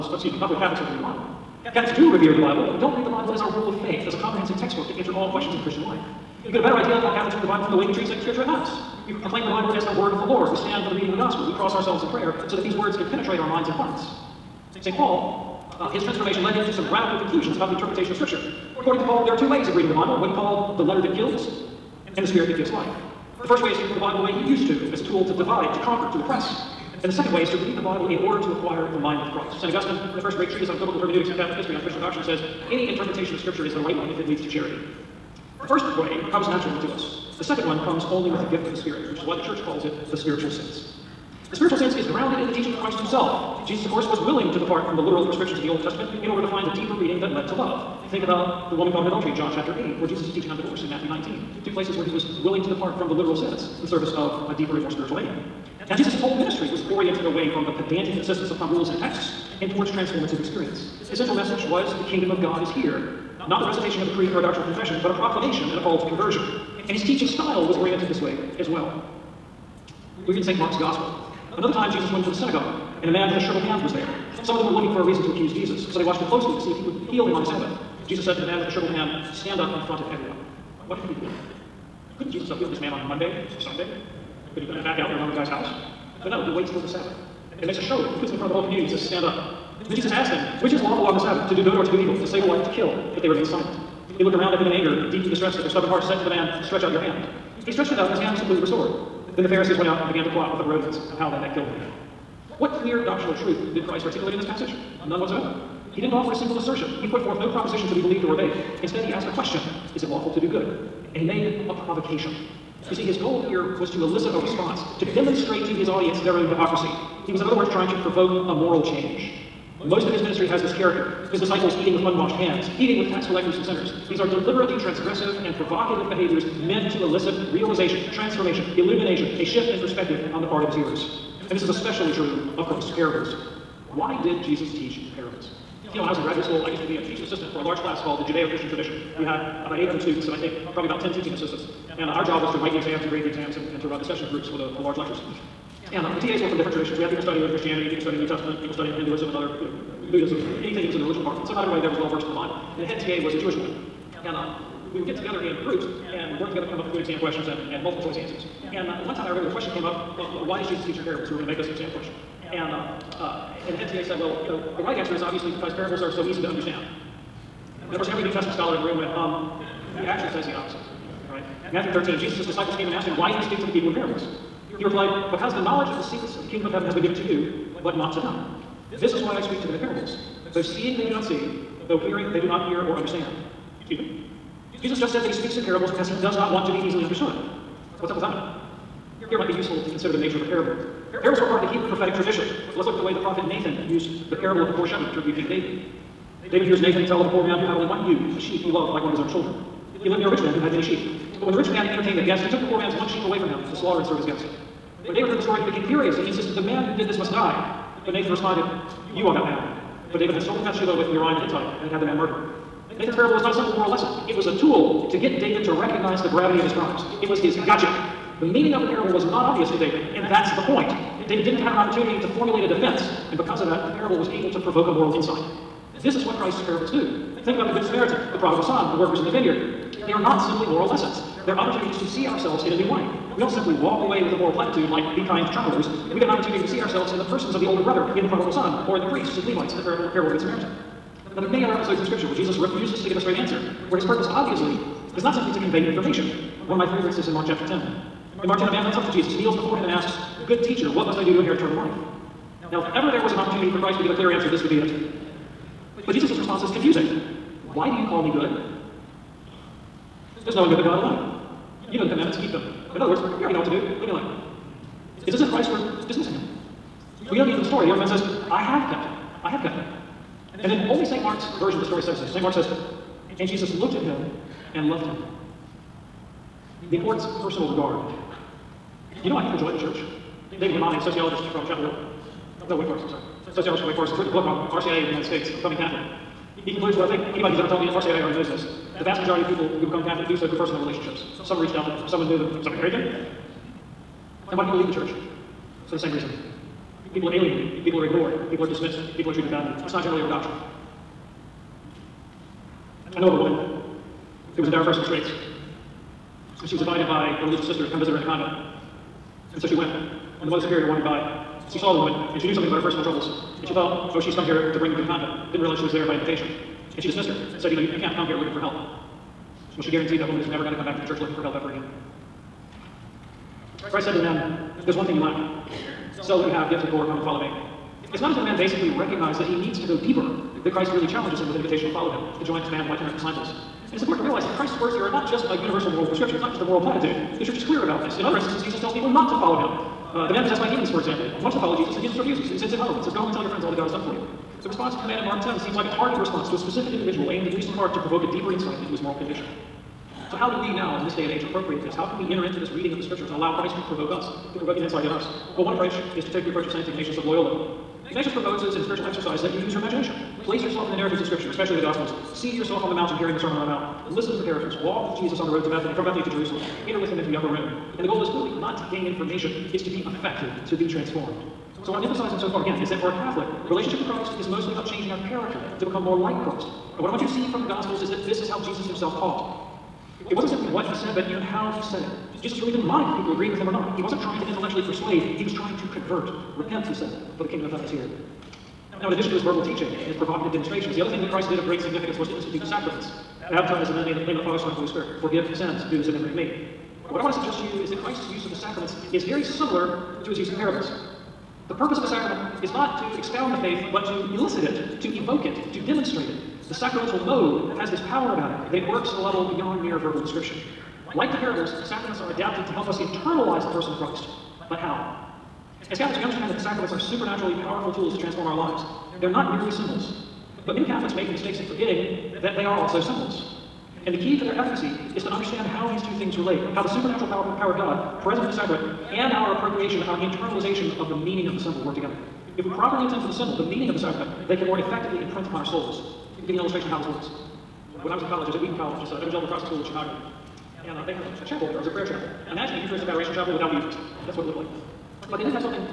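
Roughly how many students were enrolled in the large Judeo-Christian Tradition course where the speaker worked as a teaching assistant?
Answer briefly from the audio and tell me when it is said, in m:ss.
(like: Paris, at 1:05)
800, at 2:19.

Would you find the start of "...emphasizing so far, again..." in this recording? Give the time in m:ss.
6:12.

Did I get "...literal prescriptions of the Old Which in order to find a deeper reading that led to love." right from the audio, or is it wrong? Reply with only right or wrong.
wrong.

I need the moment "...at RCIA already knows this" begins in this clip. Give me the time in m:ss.
4:47.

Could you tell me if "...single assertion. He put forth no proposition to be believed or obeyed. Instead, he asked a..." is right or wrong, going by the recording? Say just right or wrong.
right.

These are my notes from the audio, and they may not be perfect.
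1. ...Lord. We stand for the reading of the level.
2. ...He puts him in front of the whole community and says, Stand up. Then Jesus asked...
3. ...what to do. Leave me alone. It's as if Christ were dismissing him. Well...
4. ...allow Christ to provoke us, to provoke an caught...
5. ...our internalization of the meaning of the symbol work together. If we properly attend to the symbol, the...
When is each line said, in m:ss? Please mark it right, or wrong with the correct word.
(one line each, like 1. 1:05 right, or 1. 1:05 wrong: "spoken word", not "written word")
1. 0:10 wrong: "gospel", not "level"
2. 1:28 right
3. 4:23 right
4. 5:53 wrong: "insight", not "caught"
5. 7:10 right.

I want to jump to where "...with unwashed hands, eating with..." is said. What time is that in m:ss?
2:01.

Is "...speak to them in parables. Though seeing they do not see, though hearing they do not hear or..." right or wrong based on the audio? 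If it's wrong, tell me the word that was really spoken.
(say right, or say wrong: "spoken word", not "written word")
right.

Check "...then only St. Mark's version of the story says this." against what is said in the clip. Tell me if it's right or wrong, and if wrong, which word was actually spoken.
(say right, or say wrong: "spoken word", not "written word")
right.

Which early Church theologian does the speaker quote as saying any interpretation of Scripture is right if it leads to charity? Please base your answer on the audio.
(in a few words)
St. Augustine.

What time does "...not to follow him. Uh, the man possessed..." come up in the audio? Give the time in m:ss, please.
5:39.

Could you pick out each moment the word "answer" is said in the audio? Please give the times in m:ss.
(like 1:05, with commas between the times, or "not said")
0:04, 2:38, 2:44, 4:03, 4:14.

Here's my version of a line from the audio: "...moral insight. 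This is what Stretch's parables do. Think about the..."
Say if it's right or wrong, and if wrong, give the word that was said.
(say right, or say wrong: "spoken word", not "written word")
wrong: "Christ", not "Stretch".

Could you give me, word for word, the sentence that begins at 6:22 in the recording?
Jesus really didn't mind if people agreed with him or not.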